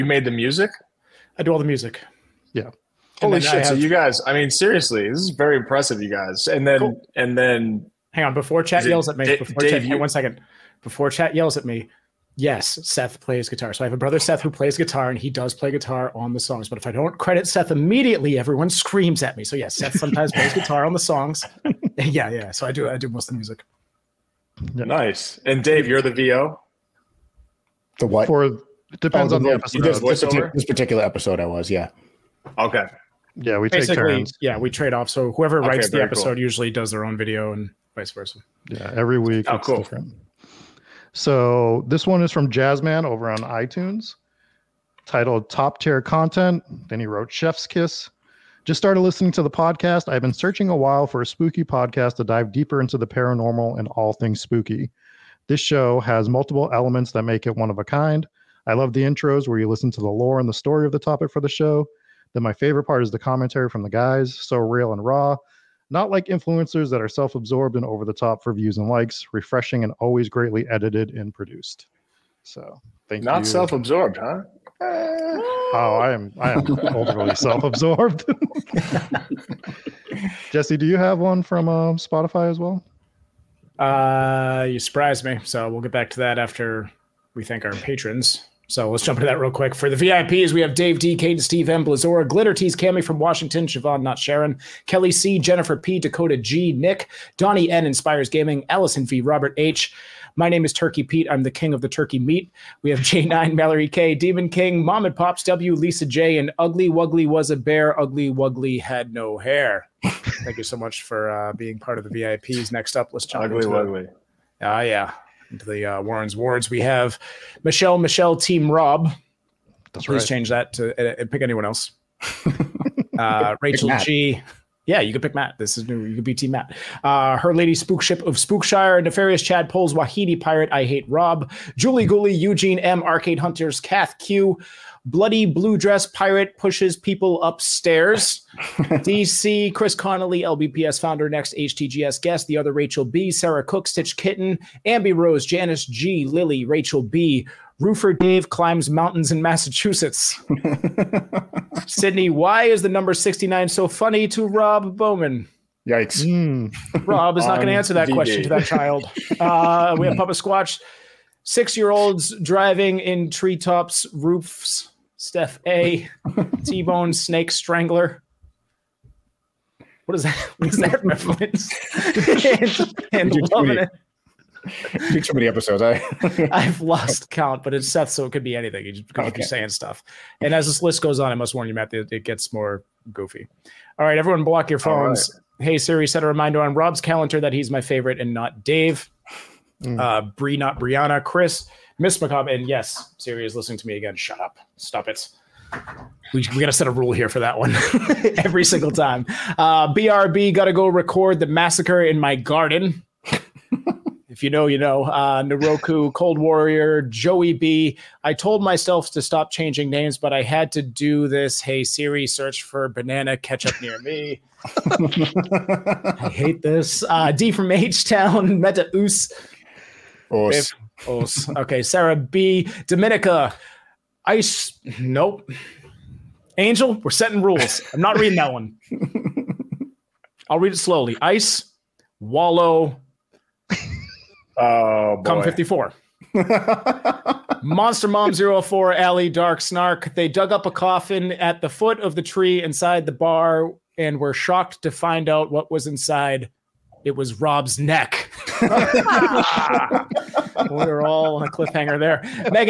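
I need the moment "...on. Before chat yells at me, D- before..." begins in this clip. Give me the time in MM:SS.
00:08.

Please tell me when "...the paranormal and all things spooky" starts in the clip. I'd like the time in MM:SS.
00:52.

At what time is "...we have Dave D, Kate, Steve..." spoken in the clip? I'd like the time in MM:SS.
01:30.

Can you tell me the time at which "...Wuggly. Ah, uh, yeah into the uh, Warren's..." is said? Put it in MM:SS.
01:53.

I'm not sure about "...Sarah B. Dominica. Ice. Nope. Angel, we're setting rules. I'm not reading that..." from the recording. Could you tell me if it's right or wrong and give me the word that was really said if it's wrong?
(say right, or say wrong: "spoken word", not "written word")
right.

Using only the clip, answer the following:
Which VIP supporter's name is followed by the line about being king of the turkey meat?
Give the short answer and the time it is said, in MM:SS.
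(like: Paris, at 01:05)
Turkey Pete, at 01:40.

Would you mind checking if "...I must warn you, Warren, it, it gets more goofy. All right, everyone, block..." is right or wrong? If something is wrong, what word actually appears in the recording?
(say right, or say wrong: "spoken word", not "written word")
wrong: "Matt", not "Warren".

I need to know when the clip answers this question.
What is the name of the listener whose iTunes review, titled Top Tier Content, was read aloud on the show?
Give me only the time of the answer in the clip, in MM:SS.
00:42.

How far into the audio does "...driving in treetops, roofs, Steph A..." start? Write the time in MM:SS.
02:42.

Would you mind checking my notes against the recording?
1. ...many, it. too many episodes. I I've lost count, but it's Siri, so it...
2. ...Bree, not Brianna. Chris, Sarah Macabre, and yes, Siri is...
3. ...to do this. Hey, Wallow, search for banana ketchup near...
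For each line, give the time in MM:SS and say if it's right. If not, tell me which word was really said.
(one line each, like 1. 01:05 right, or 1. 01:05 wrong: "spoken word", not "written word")
1. 02:53 wrong: "Seth", not "Siri"
2. 03:10 wrong: "Miss", not "Sarah"
3. 03:30 wrong: "Siri", not "Wallow".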